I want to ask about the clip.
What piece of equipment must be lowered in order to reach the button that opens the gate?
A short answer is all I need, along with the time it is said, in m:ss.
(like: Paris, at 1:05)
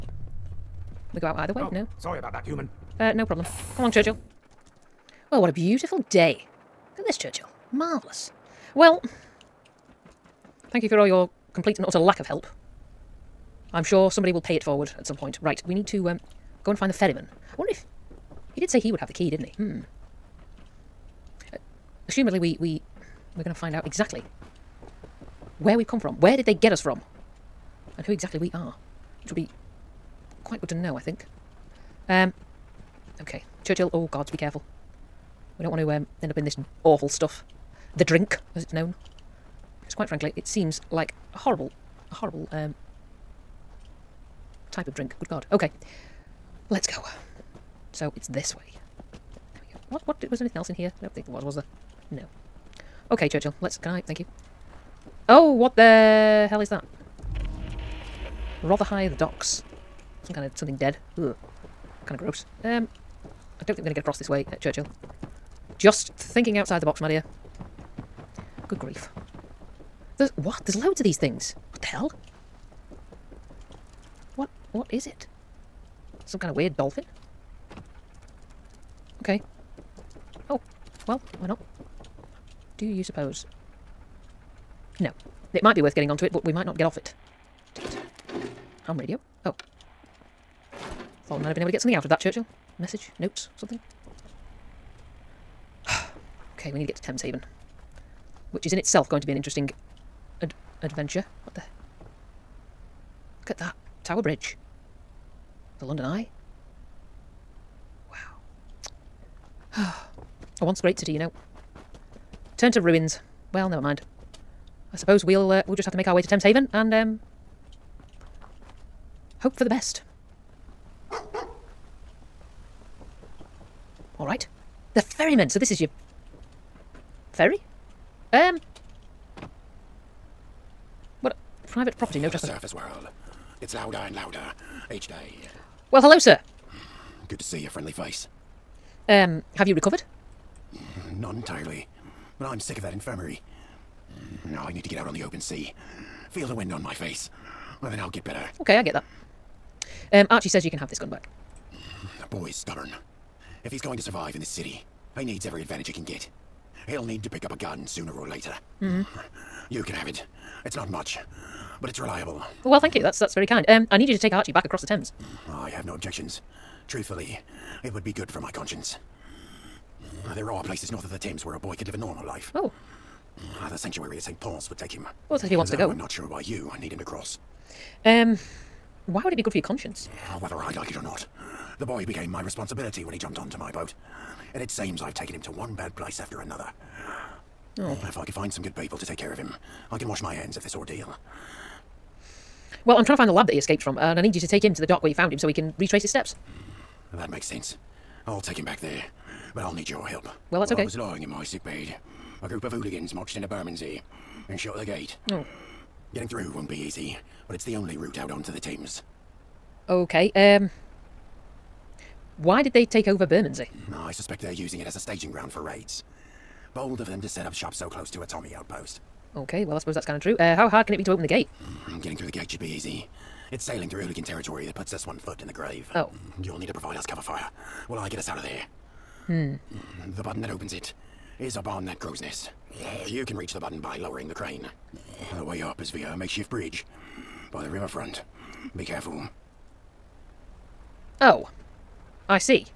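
The crane, at 3:54.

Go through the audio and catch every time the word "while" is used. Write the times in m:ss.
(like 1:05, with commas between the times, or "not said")
3:20, 3:47.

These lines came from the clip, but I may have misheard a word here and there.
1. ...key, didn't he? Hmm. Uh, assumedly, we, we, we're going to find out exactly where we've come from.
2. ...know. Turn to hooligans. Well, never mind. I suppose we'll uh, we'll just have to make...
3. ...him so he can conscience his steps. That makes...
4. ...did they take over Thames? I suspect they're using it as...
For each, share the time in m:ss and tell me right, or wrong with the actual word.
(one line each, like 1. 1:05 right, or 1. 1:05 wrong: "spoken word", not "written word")
1. 0:19 right
2. 1:51 wrong: "ruins", not "hooligans"
3. 3:15 wrong: "retrace", not "conscience"
4. 3:32 wrong: "Bermondsey", not "Thames".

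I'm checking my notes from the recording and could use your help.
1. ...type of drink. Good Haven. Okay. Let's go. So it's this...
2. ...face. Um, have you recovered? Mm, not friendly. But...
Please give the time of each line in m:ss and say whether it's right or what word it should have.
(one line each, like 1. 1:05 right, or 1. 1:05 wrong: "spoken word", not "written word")
1. 0:44 wrong: "God", not "Haven"
2. 2:17 wrong: "entirely", not "friendly".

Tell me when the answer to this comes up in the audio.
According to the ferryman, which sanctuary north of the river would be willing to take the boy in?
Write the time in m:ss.
2:54.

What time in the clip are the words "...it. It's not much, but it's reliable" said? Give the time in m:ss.
2:40.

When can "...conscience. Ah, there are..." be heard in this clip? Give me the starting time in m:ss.
2:48.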